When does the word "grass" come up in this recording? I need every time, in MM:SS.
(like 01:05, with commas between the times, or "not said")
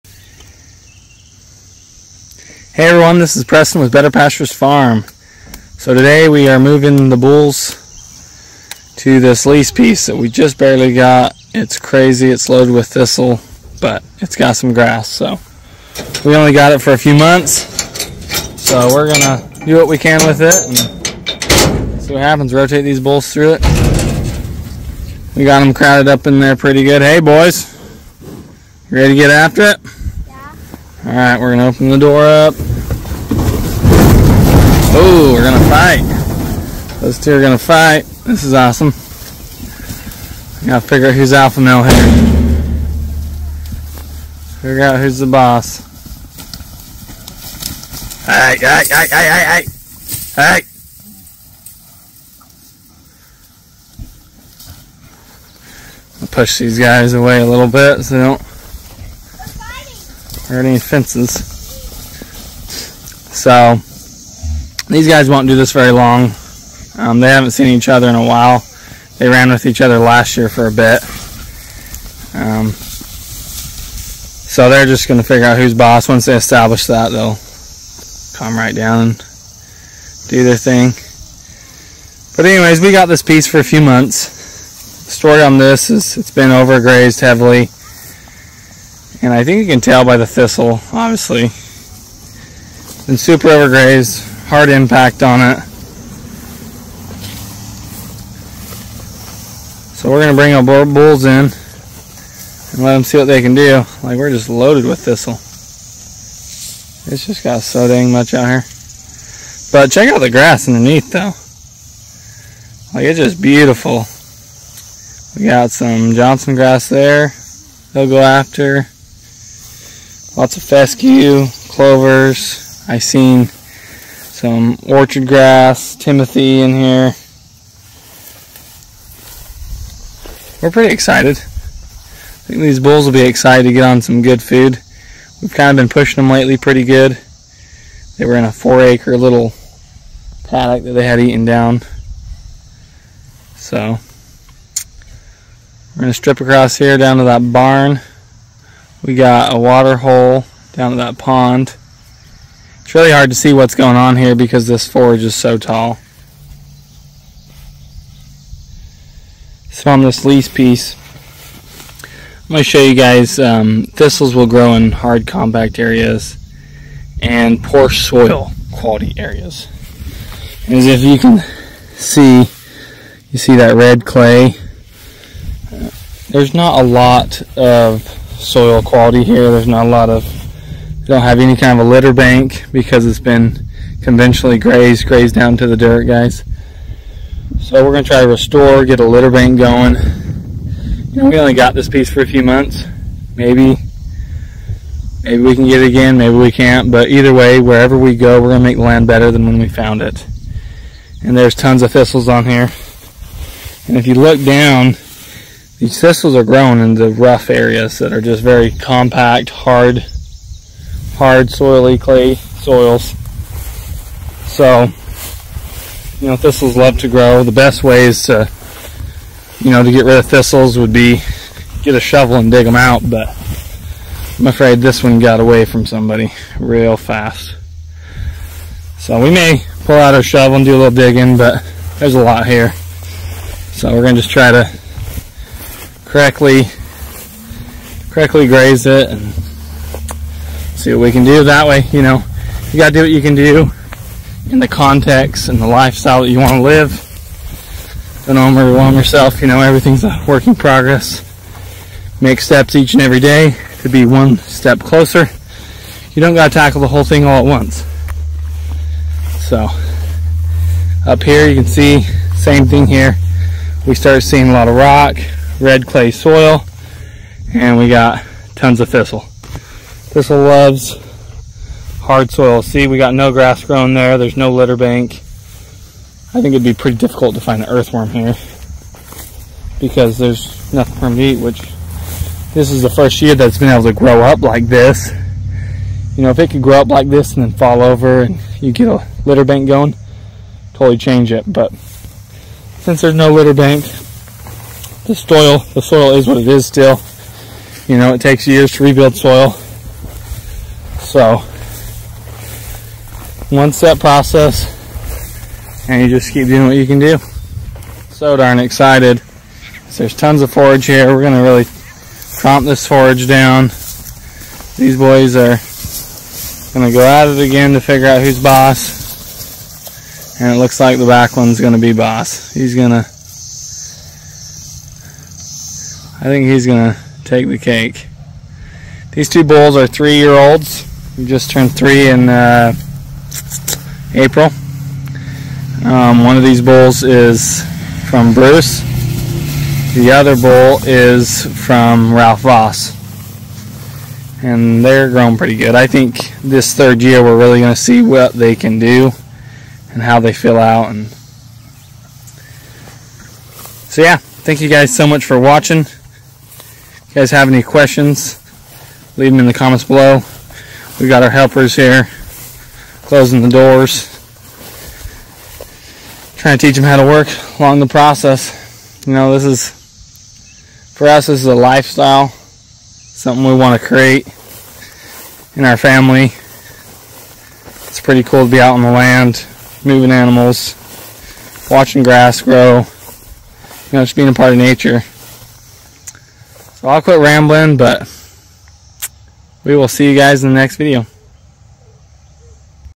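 00:14, 01:50, 01:56, 02:05, 04:33, 06:22.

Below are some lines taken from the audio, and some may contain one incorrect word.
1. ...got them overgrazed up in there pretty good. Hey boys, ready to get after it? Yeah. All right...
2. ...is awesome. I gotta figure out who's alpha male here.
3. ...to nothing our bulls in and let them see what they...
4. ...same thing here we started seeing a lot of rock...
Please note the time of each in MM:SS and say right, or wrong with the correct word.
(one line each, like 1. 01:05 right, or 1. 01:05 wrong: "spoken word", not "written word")
1. 00:25 wrong: "crowded", not "overgrazed"
2. 00:38 right
3. 01:40 wrong: "bring", not "nothing"
4. 04:22 right.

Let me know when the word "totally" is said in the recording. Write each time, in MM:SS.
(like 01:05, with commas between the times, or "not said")
04:50.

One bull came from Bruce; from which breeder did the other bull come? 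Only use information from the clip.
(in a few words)
Ralph Voss.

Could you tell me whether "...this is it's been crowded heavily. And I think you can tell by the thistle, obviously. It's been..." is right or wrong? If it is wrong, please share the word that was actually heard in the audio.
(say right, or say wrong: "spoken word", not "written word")
wrong: "overgrazed", not "crowded".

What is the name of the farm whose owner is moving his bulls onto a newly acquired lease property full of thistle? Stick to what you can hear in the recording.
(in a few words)
Better Pastures Farm.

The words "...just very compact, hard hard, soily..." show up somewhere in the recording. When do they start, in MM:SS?
03:28.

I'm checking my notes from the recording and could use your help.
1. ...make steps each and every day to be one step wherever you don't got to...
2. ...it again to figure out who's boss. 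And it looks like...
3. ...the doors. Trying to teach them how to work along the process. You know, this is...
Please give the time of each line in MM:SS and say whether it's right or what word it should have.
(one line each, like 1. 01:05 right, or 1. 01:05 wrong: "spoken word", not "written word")
1. 04:12 wrong: "closer", not "wherever"
2. 05:17 right
3. 06:03 right.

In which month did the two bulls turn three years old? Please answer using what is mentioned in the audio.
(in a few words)
April.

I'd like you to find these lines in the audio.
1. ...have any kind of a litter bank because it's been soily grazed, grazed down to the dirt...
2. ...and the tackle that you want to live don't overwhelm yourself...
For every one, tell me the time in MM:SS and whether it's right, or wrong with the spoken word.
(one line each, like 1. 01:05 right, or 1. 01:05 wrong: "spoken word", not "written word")
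1. 03:01 wrong: "conventionally", not "soily"
2. 04:05 wrong: "lifestyle", not "tackle".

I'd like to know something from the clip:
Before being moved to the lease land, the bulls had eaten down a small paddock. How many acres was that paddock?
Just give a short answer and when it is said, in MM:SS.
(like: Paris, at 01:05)
4, at 02:18.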